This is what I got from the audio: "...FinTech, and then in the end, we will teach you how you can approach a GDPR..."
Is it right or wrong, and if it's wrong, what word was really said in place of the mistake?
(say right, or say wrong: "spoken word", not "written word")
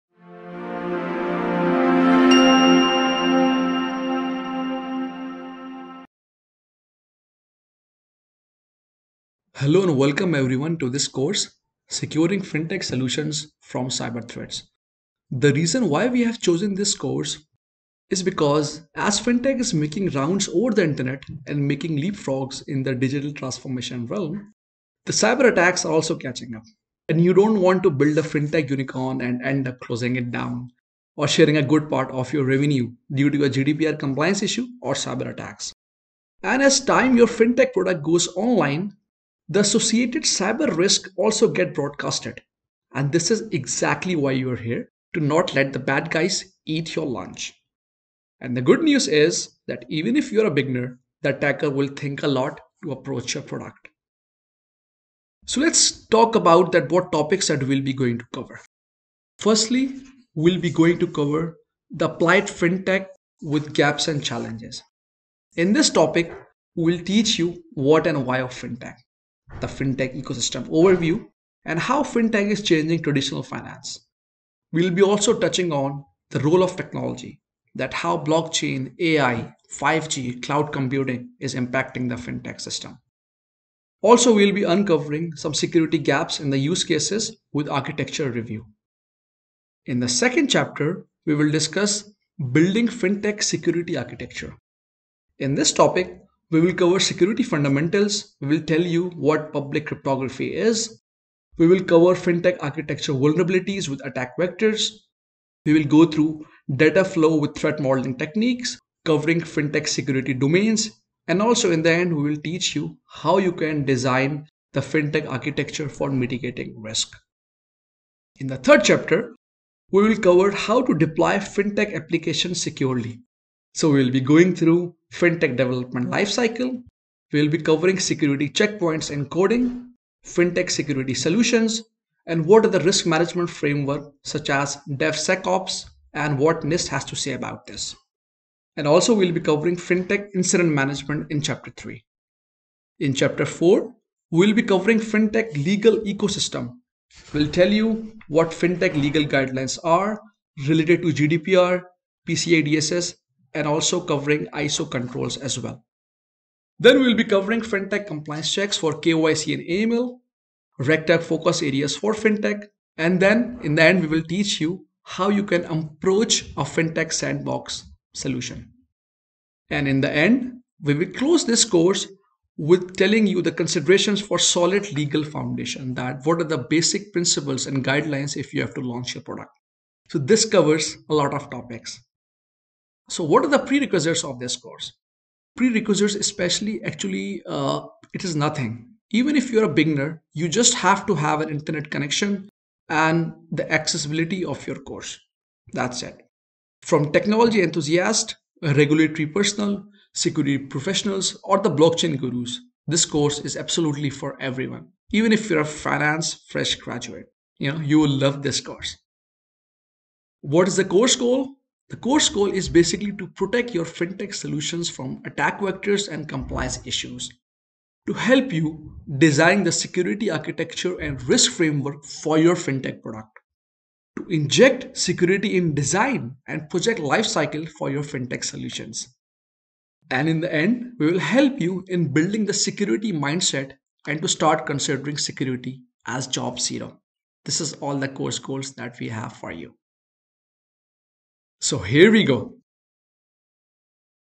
wrong: "FinTech", not "GDPR".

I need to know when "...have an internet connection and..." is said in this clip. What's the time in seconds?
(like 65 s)
191 s.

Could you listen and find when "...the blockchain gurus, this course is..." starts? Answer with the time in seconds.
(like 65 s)
201 s.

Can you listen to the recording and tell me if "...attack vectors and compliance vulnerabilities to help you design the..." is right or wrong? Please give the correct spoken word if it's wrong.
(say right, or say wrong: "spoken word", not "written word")
wrong: "issues", not "vulnerabilities".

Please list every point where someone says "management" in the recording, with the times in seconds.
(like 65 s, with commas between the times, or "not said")
133 s, 140 s.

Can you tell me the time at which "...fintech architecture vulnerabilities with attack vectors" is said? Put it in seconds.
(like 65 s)
102 s.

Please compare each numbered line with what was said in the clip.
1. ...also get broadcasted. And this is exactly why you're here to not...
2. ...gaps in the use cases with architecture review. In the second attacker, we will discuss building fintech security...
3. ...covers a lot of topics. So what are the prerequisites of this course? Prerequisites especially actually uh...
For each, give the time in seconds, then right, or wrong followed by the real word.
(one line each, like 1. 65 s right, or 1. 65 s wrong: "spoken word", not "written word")
1. 41 s right
2. 85 s wrong: "chapter", not "attacker"
3. 180 s right.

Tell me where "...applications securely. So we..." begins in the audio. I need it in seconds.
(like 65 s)
121 s.